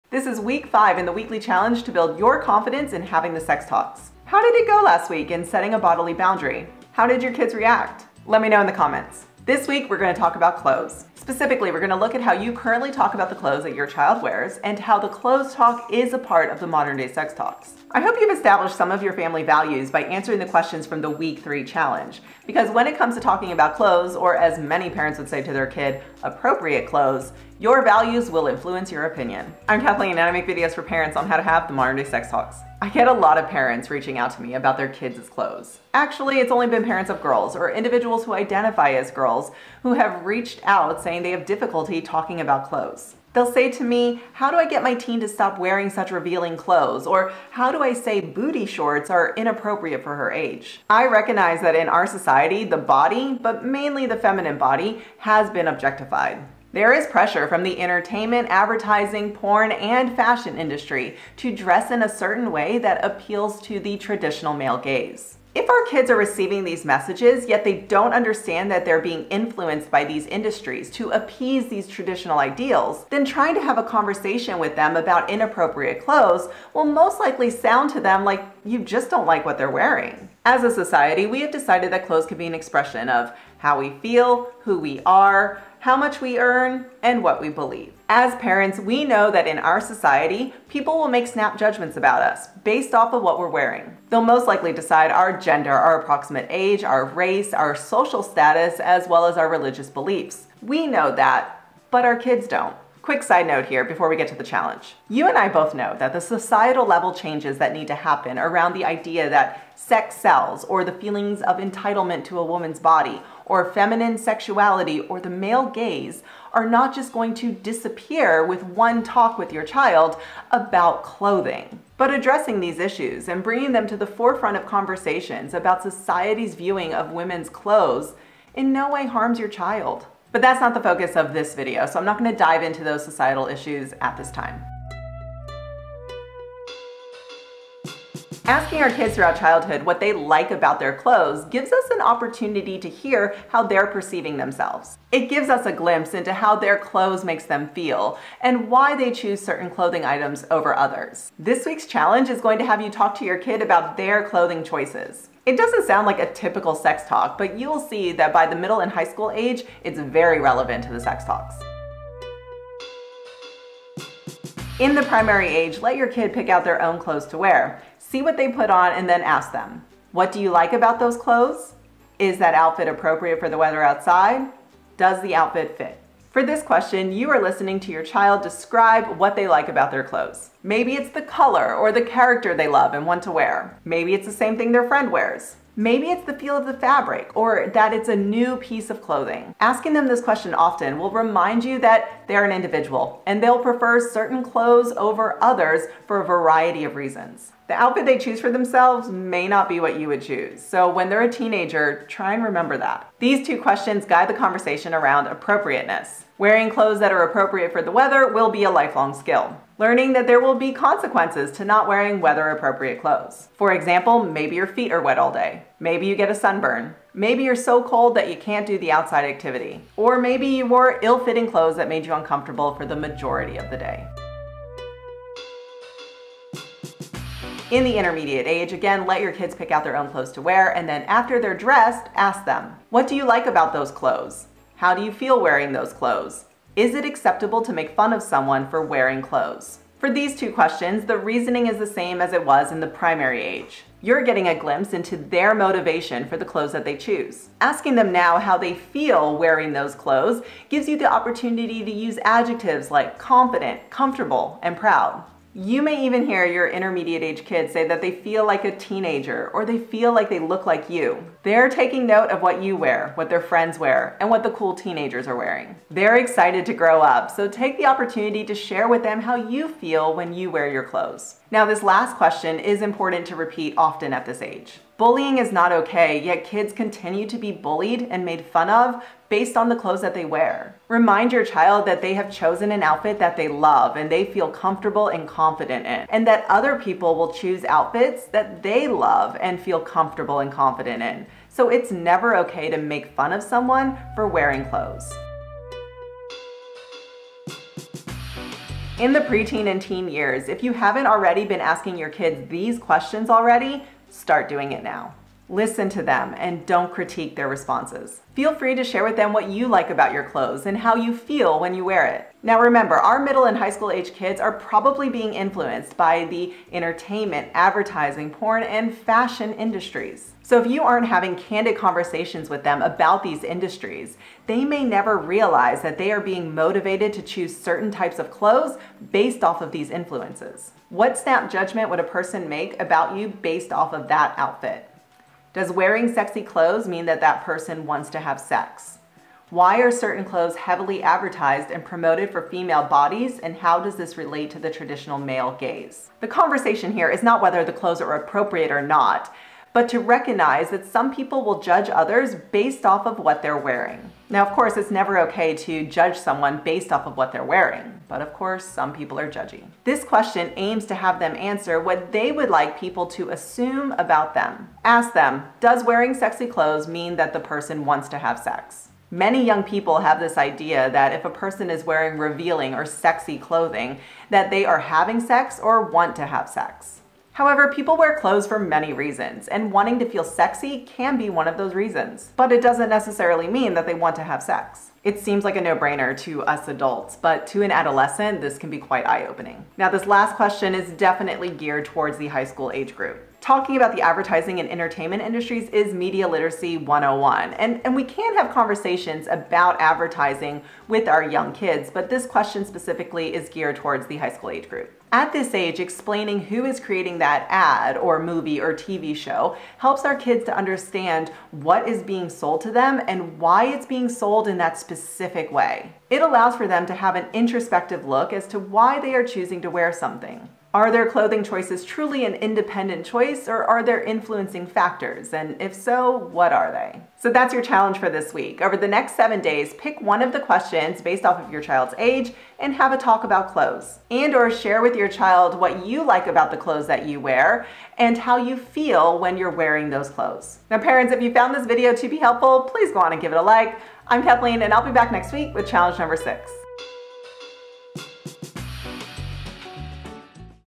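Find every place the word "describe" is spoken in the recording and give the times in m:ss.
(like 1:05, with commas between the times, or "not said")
2:58.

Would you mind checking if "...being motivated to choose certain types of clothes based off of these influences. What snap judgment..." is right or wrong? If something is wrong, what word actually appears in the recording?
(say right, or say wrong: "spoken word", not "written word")
right.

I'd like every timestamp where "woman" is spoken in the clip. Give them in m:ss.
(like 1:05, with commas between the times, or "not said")
1:52.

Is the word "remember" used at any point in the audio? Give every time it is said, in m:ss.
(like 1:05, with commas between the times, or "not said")
3:22, 5:12.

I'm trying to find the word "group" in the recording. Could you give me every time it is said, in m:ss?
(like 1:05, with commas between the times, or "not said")
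6:32, 6:44.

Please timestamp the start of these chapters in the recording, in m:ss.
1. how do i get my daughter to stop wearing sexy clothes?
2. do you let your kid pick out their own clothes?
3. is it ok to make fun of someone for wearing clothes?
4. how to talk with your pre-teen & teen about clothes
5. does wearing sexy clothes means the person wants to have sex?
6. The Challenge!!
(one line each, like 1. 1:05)
1. 0:33
2. 2:15
3. 3:45
4. 4:55
5. 6:10
6. 7:00.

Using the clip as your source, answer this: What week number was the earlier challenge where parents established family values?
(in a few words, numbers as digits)
3.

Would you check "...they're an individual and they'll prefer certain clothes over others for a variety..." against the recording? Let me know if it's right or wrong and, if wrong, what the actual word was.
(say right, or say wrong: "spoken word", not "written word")
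right.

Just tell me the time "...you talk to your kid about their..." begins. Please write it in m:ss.
2:32.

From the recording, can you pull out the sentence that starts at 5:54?
Now, of course, it's never okay to judge someone based off of what they're wearing, but of course, some people are judging.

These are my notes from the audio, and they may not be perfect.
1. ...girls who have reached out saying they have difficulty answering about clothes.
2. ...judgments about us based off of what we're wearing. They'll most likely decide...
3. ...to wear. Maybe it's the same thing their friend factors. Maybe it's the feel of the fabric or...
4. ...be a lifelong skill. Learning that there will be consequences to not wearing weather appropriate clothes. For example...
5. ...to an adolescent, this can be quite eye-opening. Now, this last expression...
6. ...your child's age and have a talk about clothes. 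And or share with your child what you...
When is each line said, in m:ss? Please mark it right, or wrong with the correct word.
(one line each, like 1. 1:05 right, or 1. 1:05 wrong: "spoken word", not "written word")
1. 0:39 wrong: "talking", not "answering"
2. 1:31 right
3. 3:03 wrong: "wears", not "factors"
4. 3:28 right
5. 6:27 wrong: "question", not "expression"
6. 7:11 right.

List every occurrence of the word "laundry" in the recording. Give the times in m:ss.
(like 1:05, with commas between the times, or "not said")
not said.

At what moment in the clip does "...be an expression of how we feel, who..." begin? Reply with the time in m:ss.
1:22.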